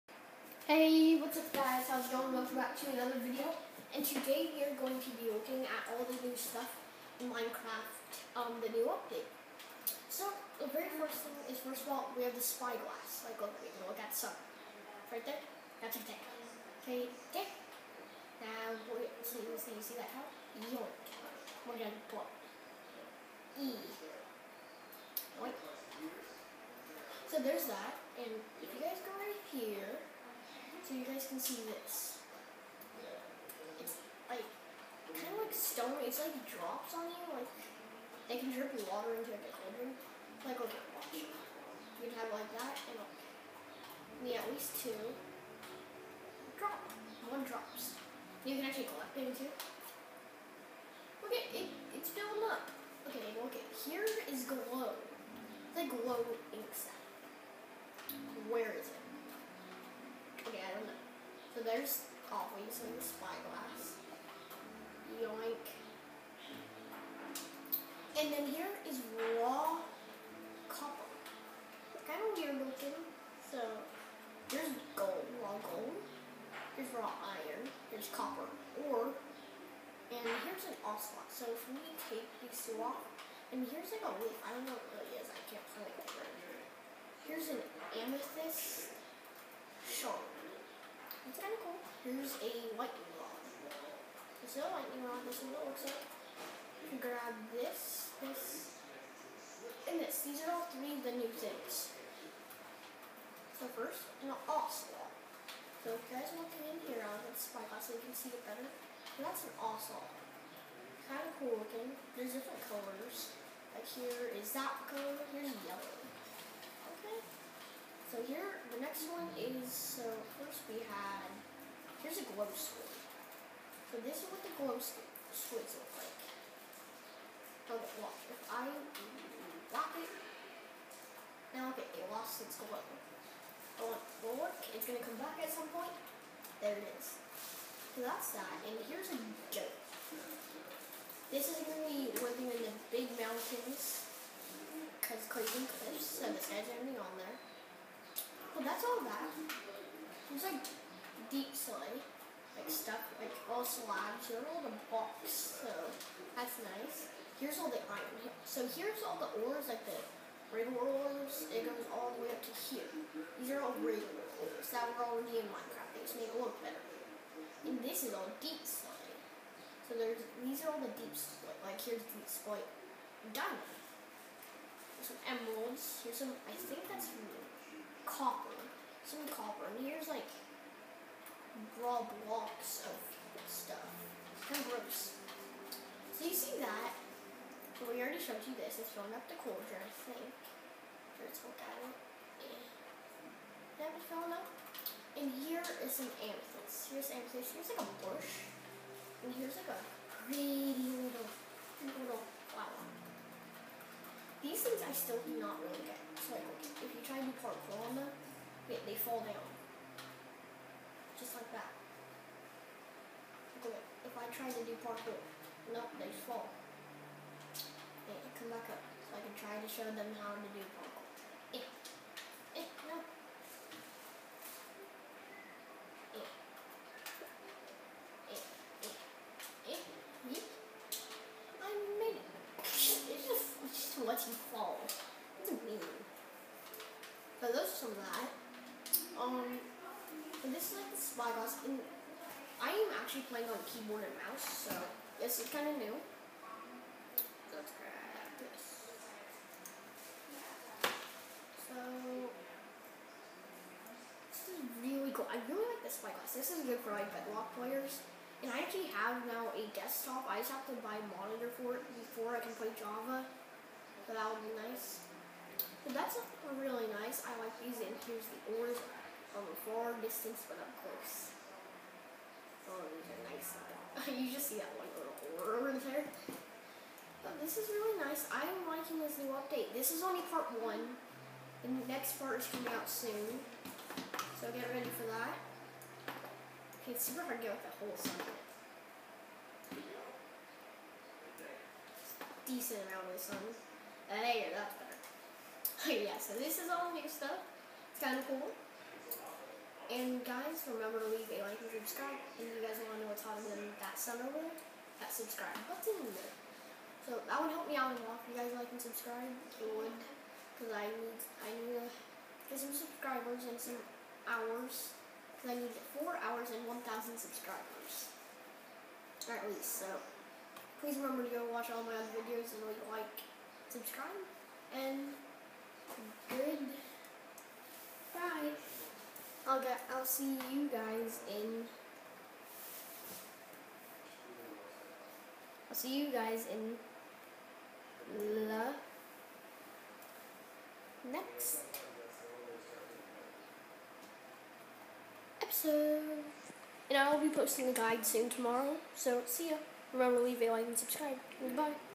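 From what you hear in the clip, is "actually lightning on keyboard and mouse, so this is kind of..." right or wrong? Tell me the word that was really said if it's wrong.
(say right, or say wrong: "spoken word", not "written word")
wrong: "playing", not "lightning".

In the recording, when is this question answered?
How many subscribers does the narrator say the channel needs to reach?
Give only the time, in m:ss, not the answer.
5:16.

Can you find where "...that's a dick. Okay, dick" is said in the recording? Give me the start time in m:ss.
0:15.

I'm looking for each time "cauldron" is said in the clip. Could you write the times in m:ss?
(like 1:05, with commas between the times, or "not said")
0:39, 3:09.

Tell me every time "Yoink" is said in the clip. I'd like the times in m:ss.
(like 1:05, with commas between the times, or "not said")
0:20, 0:25, 1:05.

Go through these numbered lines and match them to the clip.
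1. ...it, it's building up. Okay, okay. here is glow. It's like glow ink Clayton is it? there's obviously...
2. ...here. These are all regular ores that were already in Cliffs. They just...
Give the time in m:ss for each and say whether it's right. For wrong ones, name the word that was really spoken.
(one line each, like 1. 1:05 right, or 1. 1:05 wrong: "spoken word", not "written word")
1. 0:51 wrong: "Where", not "Clayton"
2. 2:42 wrong: "Minecraft", not "Cliffs".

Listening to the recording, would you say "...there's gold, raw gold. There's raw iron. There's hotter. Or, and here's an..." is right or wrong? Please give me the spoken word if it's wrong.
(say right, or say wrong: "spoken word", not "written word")
wrong: "copper", not "hotter".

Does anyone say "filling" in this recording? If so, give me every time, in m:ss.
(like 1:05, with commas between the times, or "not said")
3:08, 3:14.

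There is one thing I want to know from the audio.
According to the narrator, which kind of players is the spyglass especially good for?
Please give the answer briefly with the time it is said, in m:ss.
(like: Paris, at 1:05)
Bedrock players, at 4:17.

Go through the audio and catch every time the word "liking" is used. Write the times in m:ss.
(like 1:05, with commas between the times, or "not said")
4:38.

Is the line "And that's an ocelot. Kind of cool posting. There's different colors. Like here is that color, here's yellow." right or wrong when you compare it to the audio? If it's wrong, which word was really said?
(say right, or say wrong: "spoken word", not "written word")
wrong: "looking", not "posting".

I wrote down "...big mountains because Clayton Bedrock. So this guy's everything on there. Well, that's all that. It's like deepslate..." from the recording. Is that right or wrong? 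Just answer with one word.
wrong.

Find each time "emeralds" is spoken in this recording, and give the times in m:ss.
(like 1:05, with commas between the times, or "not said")
2:55.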